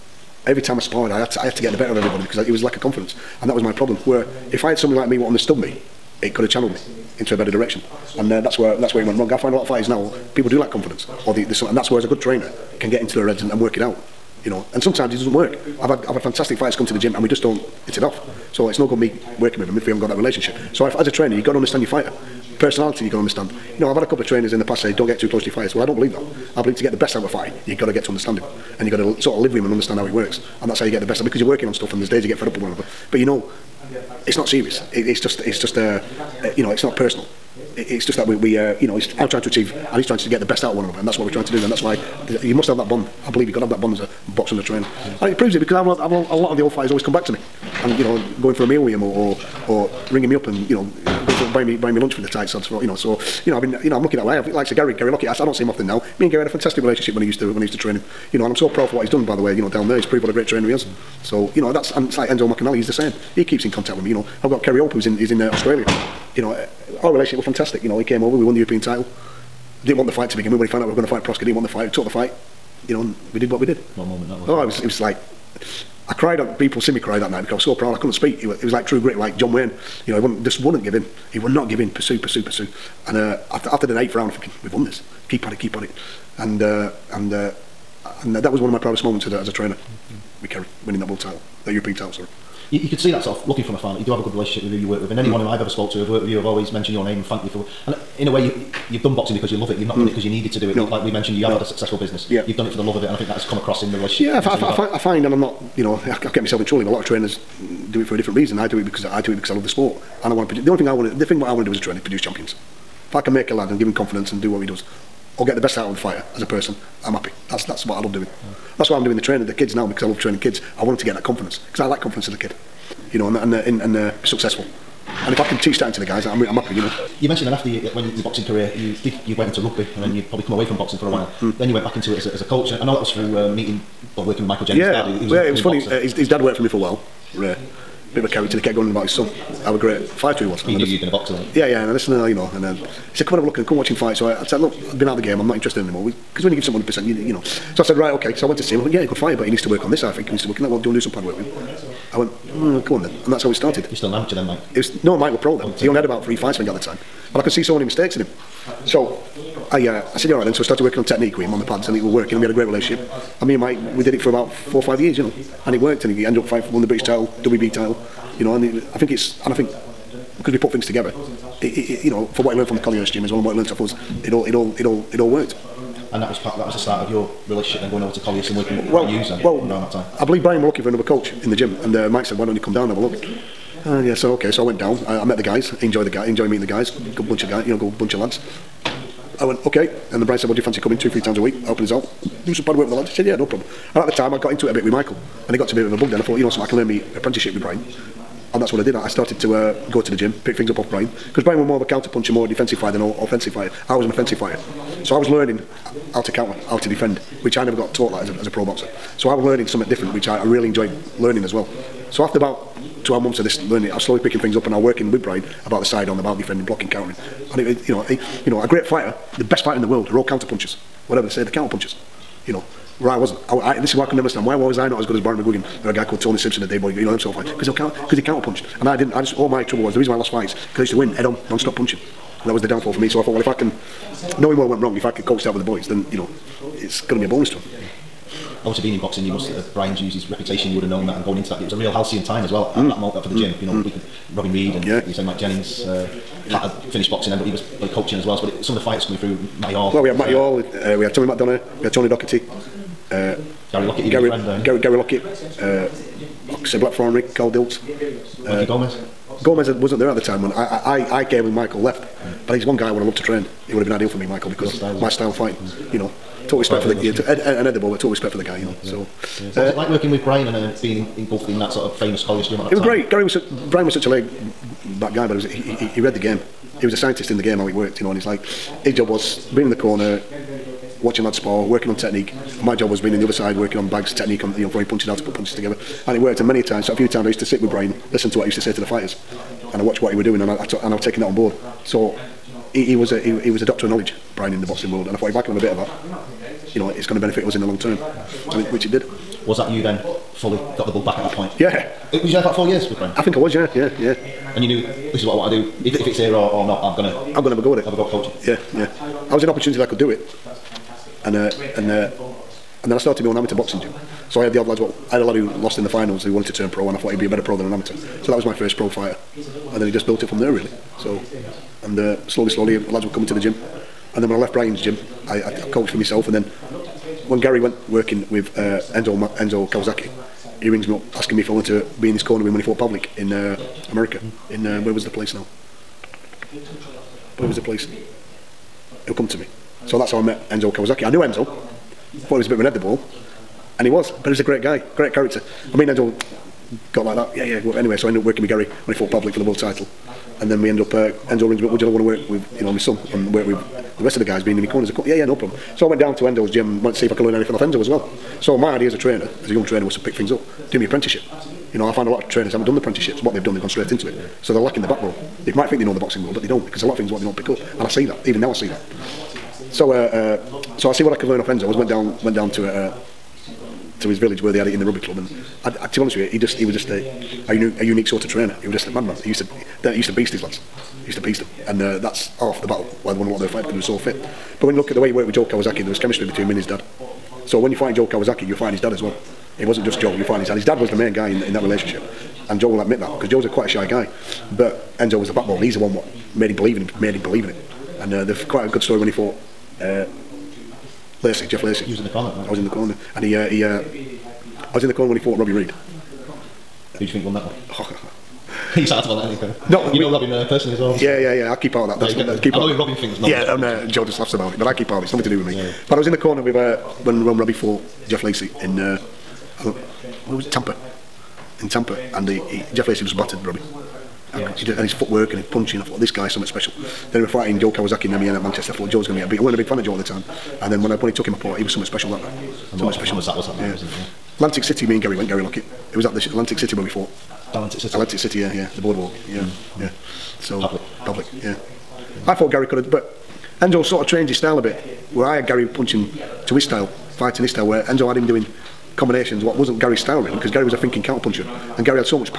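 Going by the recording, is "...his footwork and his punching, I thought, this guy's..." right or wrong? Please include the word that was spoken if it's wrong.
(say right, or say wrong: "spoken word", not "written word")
right.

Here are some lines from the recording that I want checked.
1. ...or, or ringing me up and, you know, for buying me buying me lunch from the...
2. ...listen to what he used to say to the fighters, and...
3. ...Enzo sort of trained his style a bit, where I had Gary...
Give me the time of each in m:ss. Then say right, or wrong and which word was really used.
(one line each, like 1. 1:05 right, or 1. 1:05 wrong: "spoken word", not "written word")
1. 0:49 right
2. 4:48 right
3. 7:23 right.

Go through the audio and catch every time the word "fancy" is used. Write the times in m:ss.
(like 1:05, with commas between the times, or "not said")
3:10.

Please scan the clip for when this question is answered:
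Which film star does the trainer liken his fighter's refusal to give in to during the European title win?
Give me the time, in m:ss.
1:19.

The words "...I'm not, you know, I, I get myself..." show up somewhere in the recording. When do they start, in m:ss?
1:45.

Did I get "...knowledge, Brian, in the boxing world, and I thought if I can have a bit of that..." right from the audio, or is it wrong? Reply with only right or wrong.
right.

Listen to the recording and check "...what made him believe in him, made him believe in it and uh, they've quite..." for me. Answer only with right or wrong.
right.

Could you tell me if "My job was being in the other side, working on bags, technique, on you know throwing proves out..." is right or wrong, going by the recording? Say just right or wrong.
wrong.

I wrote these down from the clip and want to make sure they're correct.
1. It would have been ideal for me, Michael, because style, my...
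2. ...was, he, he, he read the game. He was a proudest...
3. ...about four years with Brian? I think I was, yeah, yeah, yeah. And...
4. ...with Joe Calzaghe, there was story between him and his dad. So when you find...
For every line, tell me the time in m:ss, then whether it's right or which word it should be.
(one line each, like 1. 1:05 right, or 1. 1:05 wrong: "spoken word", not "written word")
1. 4:23 right
2. 4:35 wrong: "scientist", not "proudest"
3. 5:02 right
4. 6:25 wrong: "chemistry", not "story".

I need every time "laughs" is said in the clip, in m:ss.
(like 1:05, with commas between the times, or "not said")
6:54.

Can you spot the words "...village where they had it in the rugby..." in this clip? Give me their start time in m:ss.
6:14.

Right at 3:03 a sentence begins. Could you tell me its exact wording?
Uh, yeah, so okay, so I went down.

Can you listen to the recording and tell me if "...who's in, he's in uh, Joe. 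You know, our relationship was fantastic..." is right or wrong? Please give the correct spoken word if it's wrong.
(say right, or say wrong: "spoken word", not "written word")
wrong: "Australia", not "Joe".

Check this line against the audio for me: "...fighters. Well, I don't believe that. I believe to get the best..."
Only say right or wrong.
right.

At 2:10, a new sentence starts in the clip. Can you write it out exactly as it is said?
you probably come away from boxing for a while.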